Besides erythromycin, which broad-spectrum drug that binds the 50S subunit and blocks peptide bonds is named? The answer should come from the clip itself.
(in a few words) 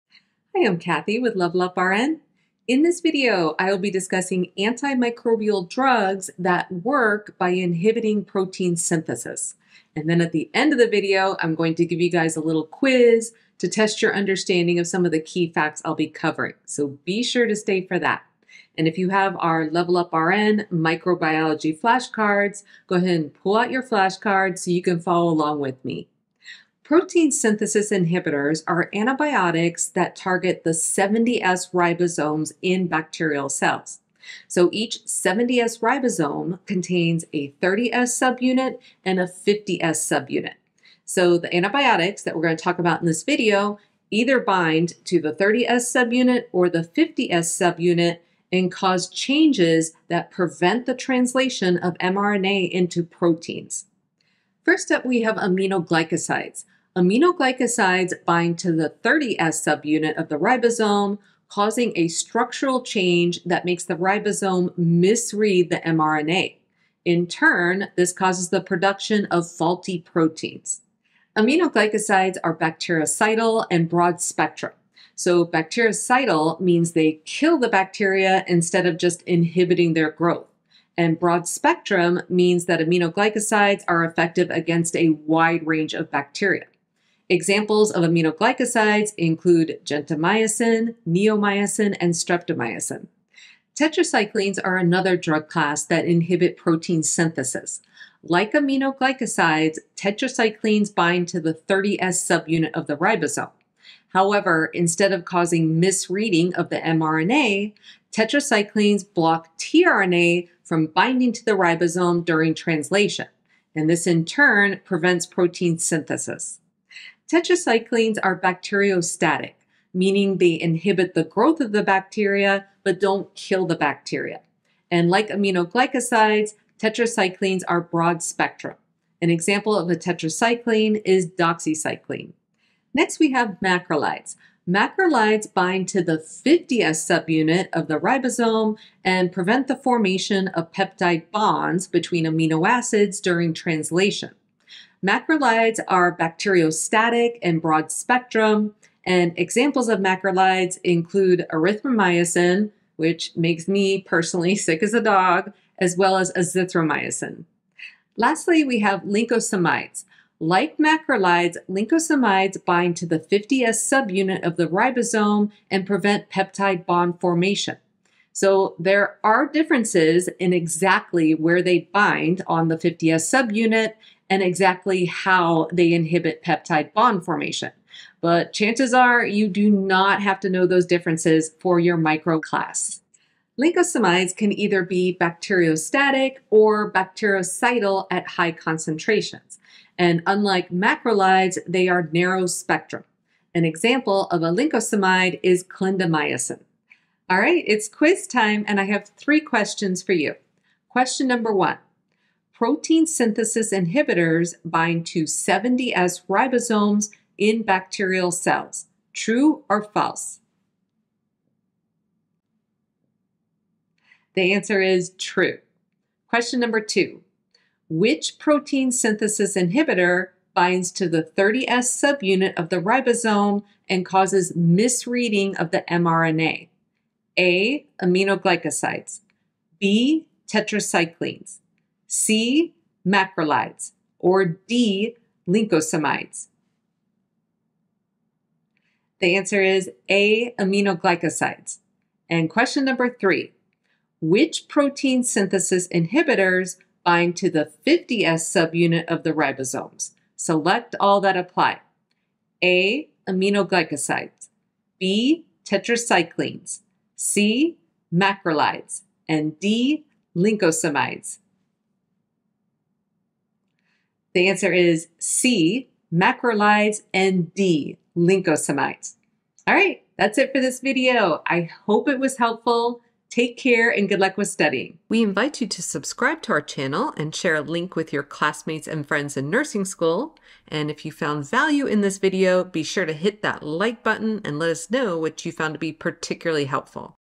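Azithromycin.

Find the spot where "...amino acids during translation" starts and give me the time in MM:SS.
02:22.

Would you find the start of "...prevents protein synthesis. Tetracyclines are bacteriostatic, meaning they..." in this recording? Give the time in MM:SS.
01:54.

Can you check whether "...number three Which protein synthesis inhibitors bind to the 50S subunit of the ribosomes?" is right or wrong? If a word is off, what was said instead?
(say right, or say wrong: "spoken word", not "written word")
right.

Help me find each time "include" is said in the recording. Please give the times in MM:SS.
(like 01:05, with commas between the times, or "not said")
01:29, 02:30.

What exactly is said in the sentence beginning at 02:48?
So there are differences in exactly where they bind on the 50S subunit, and exactly how they inhibit peptide bond formation.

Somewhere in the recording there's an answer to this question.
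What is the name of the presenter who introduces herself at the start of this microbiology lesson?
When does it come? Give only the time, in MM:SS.
00:00.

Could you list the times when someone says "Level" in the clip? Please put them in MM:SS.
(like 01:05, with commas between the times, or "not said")
00:01, 00:19.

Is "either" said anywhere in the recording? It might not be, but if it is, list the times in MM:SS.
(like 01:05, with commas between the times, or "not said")
00:44, 03:04.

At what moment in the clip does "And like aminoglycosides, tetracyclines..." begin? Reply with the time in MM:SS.
02:04.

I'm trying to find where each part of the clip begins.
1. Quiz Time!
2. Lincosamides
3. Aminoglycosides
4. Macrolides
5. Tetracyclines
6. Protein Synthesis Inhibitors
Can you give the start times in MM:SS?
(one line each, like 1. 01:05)
1. 03:16
2. 02:37
3. 00:54
4. 02:12
5. 01:33
6. 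00:26.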